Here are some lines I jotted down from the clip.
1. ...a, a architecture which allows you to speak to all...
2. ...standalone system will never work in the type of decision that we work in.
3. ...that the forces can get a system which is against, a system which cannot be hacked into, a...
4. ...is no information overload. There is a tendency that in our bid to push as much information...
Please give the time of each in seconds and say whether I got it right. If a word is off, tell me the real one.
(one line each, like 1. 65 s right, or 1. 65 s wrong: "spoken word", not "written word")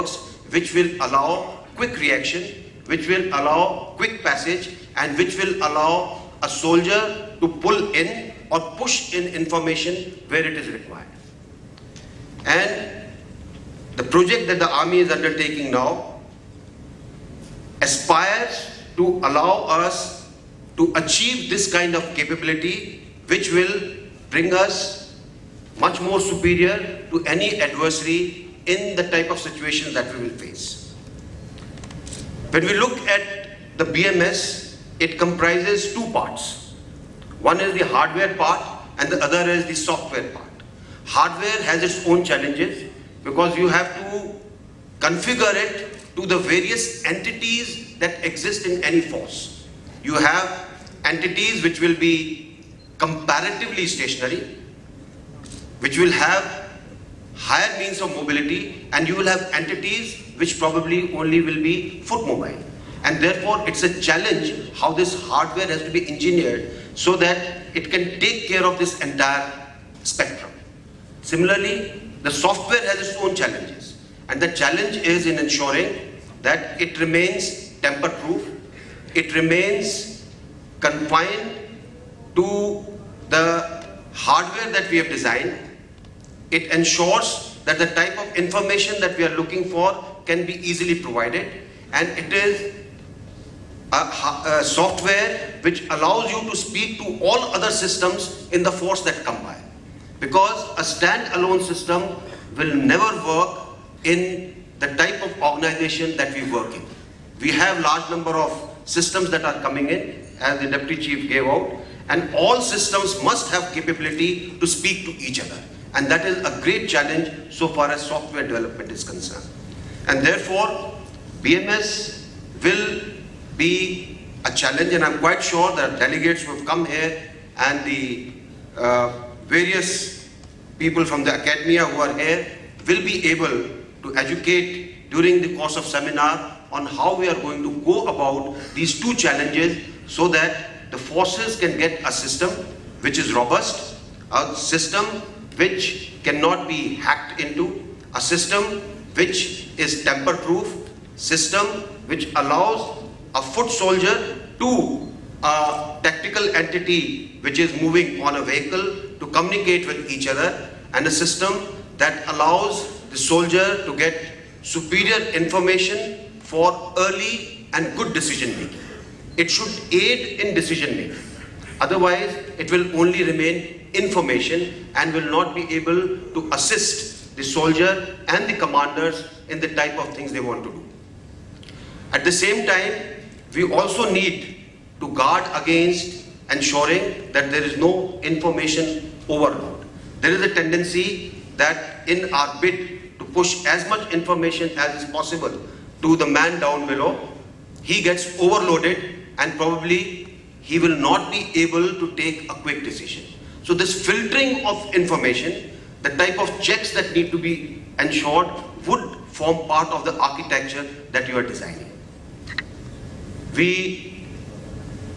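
1. 93 s wrong: "software", not "architecture"
2. 100 s wrong: "organization", not "decision"
3. 140 s wrong: "robust", not "against"
4. 187 s right.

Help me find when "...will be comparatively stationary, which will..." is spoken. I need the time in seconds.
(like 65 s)
51 s.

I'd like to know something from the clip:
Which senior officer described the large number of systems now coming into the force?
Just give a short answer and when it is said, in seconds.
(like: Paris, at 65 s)
The deputy chief, at 110 s.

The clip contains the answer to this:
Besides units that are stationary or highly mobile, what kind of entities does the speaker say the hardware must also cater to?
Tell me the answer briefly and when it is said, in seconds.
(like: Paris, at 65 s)
Foot mobile, at 62 s.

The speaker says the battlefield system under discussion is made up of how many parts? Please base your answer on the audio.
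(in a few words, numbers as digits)
2.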